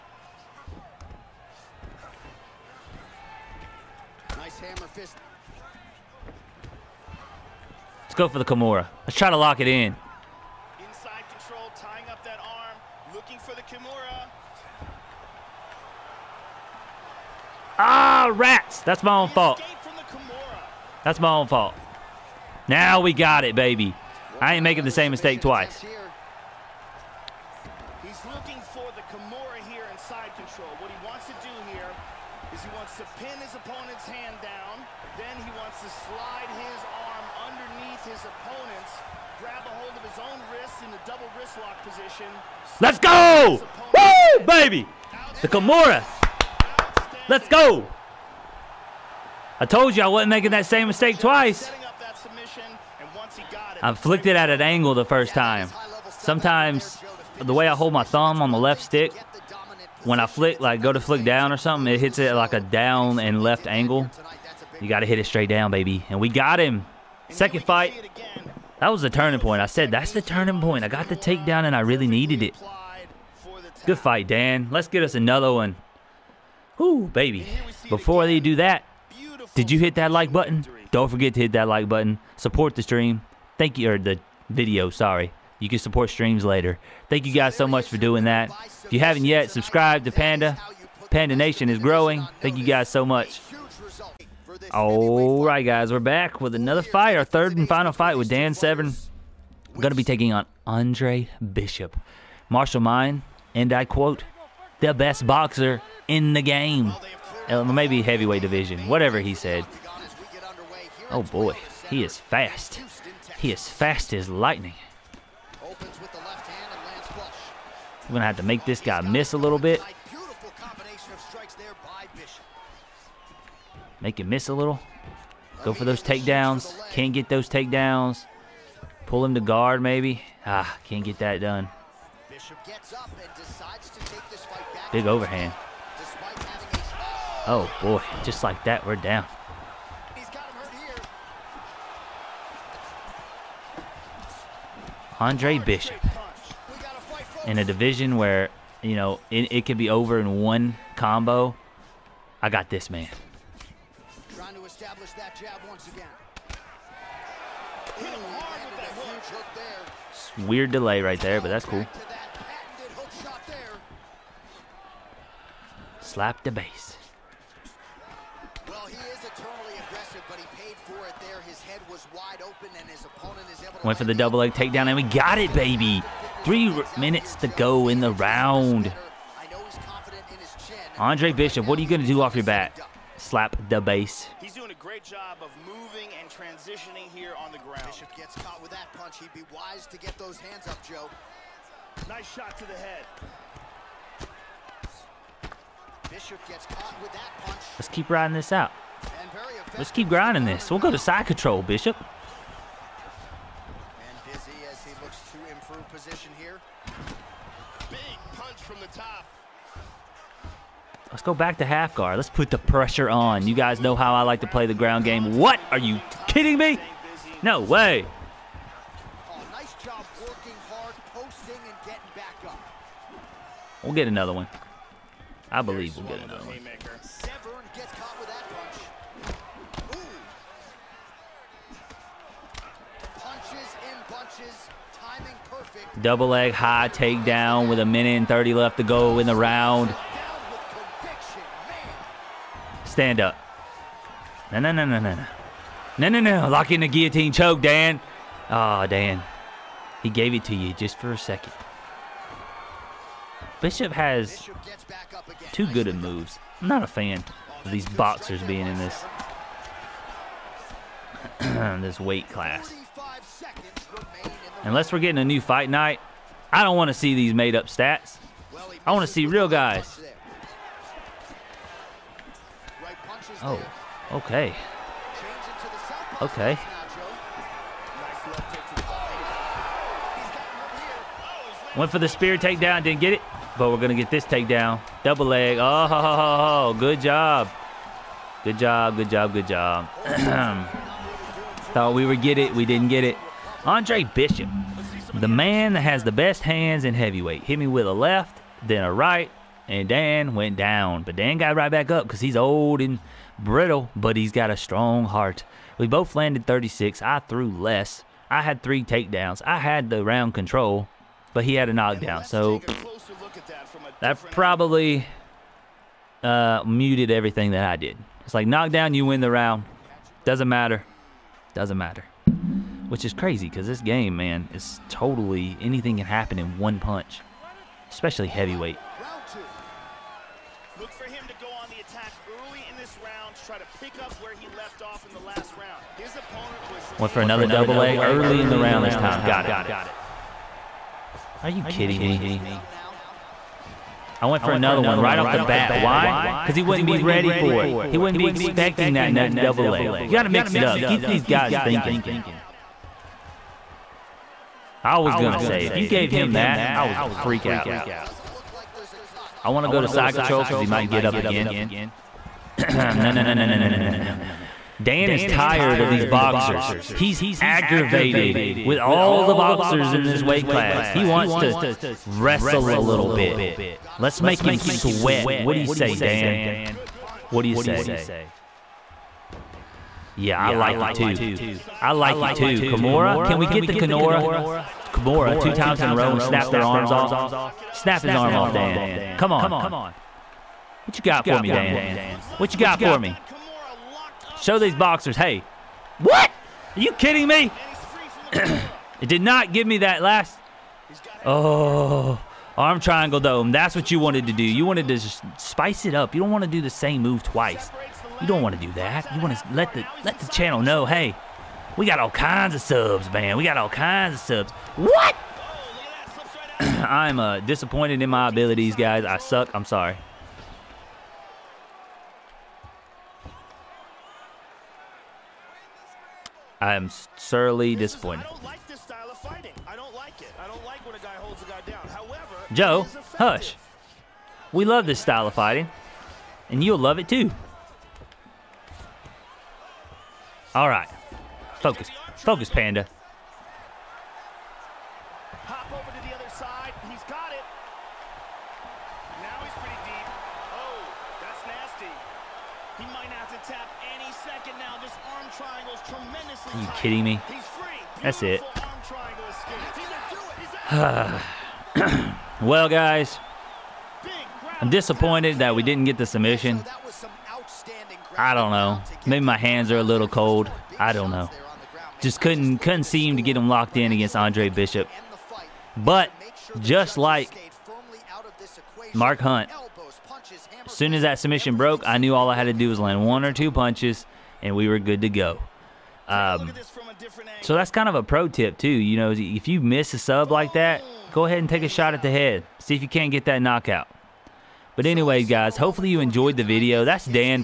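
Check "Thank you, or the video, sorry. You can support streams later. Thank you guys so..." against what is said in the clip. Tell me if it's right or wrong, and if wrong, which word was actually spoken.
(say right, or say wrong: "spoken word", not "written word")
right.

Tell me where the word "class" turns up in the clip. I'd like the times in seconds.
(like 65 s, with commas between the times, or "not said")
262 s, 370 s.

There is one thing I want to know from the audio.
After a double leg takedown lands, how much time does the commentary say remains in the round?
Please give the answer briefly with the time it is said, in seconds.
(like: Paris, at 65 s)
3 minutes, at 176 s.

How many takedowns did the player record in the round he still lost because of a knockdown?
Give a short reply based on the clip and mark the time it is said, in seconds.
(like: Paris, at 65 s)
3, at 308 s.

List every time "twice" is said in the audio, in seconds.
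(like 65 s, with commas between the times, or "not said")
25 s, 51 s, 407 s.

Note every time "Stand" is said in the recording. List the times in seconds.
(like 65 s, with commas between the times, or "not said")
242 s.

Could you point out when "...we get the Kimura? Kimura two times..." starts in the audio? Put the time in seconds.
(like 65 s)
383 s.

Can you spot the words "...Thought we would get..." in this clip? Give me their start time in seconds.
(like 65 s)
291 s.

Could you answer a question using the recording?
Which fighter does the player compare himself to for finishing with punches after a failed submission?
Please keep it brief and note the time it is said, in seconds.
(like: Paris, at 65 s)
Mark Hunt, at 478 s.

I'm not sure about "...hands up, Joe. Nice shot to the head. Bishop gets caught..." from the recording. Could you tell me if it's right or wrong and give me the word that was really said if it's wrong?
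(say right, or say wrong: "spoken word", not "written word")
right.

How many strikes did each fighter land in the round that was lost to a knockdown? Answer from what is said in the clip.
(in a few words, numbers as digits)
36.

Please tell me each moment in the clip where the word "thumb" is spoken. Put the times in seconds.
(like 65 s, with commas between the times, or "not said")
58 s.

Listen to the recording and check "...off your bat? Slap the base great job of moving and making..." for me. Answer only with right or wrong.
wrong.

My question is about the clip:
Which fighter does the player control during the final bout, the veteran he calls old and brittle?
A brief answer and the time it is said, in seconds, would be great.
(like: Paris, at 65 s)
Dan Severn, at 98 s.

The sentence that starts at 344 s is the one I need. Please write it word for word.
I went for another one right off the bat.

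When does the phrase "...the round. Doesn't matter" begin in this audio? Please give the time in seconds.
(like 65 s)
319 s.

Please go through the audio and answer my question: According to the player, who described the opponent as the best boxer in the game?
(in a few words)
Marshall Mine.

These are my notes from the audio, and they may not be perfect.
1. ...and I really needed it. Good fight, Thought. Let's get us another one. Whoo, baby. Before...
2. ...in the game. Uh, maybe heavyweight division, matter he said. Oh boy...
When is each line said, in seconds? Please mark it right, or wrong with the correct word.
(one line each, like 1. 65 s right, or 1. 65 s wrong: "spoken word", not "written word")
1. 71 s wrong: "Dan", not "Thought"
2. 106 s wrong: "whatever", not "matter".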